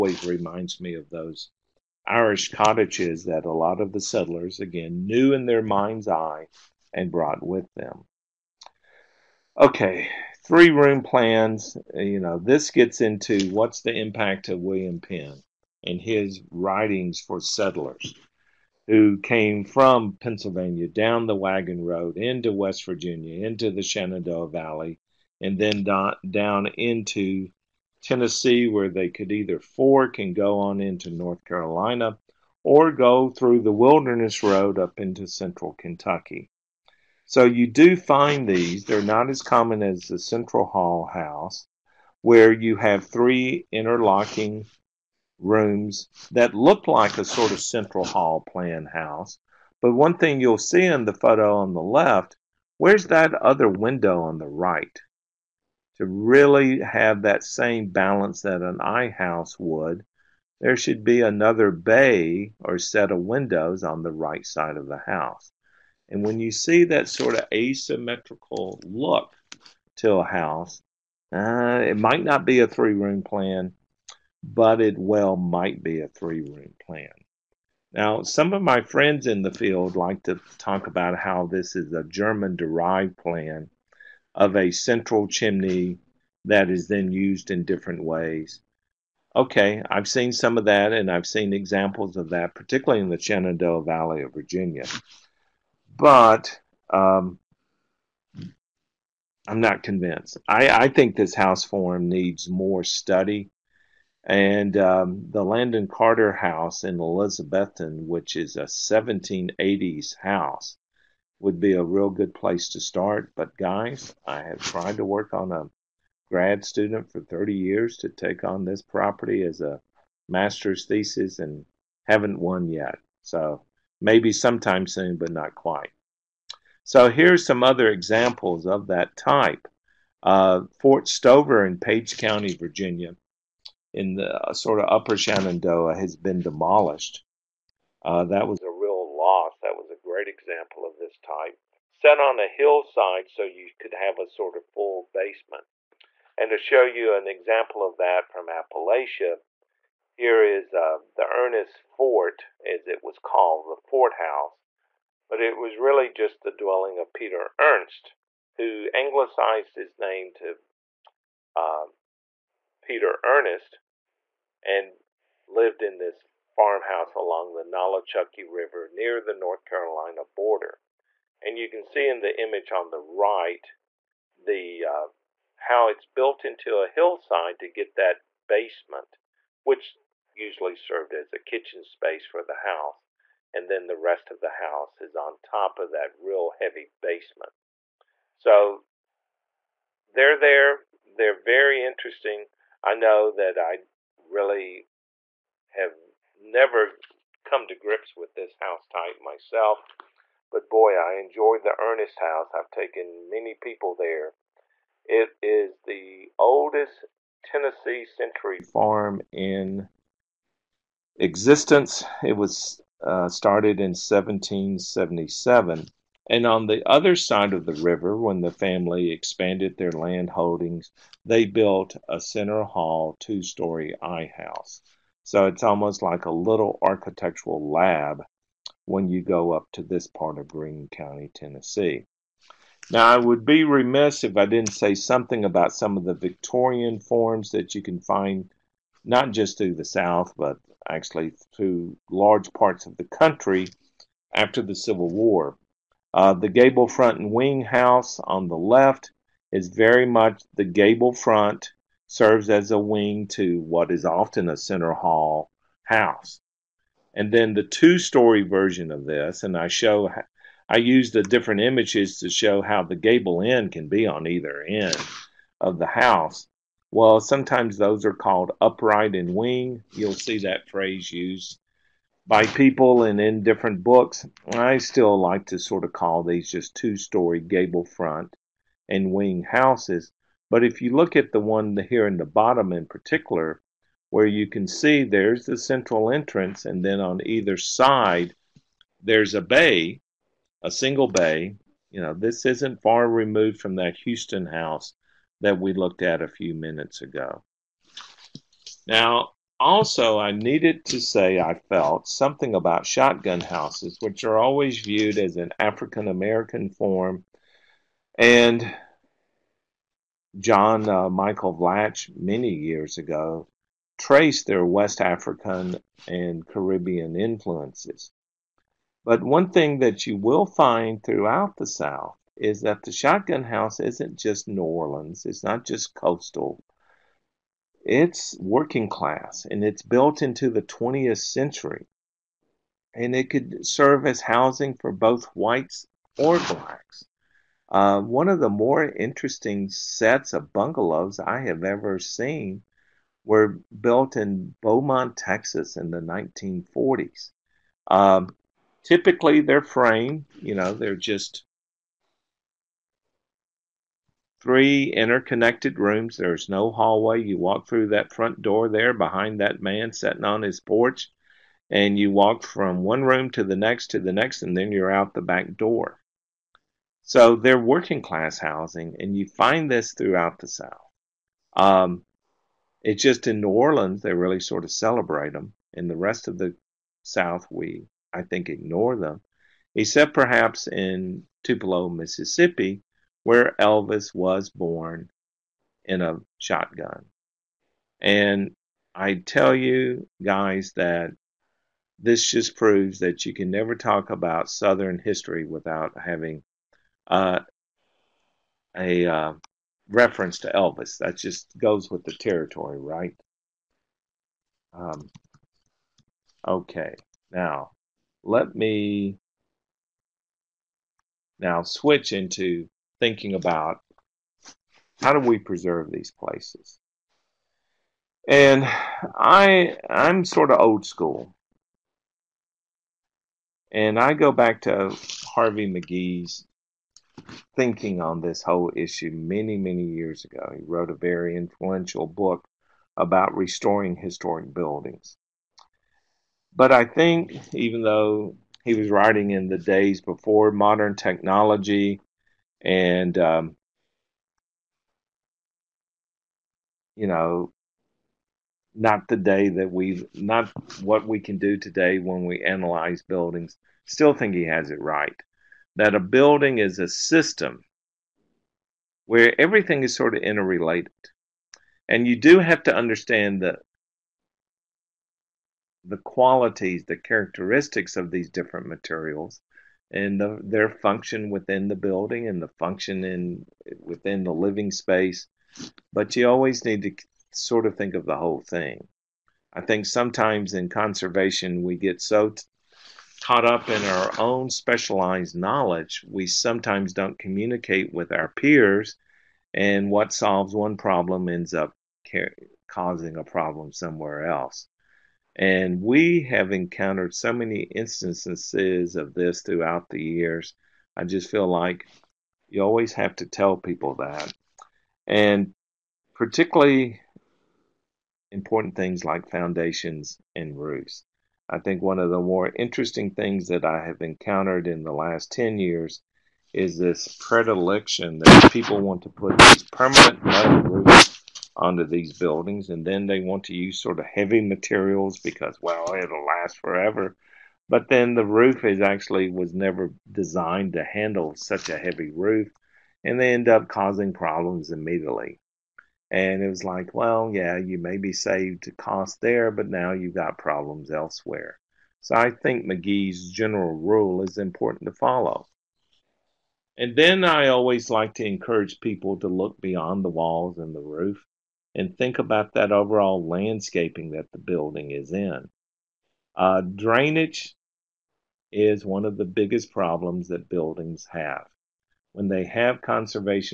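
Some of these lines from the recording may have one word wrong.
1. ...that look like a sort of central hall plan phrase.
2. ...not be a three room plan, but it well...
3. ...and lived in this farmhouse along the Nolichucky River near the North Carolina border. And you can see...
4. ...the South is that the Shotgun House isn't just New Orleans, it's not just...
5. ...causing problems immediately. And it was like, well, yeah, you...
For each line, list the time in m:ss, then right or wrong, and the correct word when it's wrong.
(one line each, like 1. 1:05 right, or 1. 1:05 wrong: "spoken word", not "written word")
1. 0:46 wrong: "house", not "phrase"
2. 1:12 right
3. 2:44 right
4. 5:21 right
5. 8:53 right.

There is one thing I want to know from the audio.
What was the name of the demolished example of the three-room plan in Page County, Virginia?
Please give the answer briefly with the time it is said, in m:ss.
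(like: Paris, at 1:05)
Fort Stover, at 2:10.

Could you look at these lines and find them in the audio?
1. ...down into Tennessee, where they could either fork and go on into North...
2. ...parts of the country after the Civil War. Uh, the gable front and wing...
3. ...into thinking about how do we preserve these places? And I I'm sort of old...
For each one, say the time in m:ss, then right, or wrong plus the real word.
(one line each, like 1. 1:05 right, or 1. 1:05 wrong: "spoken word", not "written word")
1. 0:25 right
2. 4:02 right
3. 6:52 right.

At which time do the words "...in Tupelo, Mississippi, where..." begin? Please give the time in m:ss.
6:20.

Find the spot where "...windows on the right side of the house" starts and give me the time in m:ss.
1:03.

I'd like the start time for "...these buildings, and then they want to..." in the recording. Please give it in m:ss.
8:41.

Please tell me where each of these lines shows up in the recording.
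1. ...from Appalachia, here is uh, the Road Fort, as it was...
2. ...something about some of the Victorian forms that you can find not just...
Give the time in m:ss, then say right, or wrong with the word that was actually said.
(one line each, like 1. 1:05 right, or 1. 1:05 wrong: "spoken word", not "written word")
1. 2:28 wrong: "Ernest", not "Road"
2. 3:54 right.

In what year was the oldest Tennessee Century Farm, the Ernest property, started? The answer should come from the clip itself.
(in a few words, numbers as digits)
1777.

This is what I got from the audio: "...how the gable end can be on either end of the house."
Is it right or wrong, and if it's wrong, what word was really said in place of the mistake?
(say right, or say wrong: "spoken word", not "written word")
right.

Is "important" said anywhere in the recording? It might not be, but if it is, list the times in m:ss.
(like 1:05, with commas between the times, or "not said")
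8:28, 9:04.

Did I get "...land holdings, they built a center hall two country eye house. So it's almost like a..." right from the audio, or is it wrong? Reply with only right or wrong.
wrong.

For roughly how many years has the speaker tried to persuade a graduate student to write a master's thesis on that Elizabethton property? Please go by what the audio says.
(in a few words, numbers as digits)
30.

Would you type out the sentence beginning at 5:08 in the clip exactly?
And John uh, Michael Vlach, many years ago, traced their West African and Caribbean influences.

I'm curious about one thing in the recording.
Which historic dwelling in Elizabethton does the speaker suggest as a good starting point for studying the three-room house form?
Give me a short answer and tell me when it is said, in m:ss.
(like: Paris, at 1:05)
Landon Carter House, at 1:45.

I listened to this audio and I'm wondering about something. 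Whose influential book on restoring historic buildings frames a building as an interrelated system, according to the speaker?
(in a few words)
Harley McKee.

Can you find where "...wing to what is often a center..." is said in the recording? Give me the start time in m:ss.
4:12.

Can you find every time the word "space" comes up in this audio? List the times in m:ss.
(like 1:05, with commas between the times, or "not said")
3:01, 7:54.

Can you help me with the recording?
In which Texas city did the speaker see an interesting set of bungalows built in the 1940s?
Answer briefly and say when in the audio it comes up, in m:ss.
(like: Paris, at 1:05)
Beaumont, at 5:44.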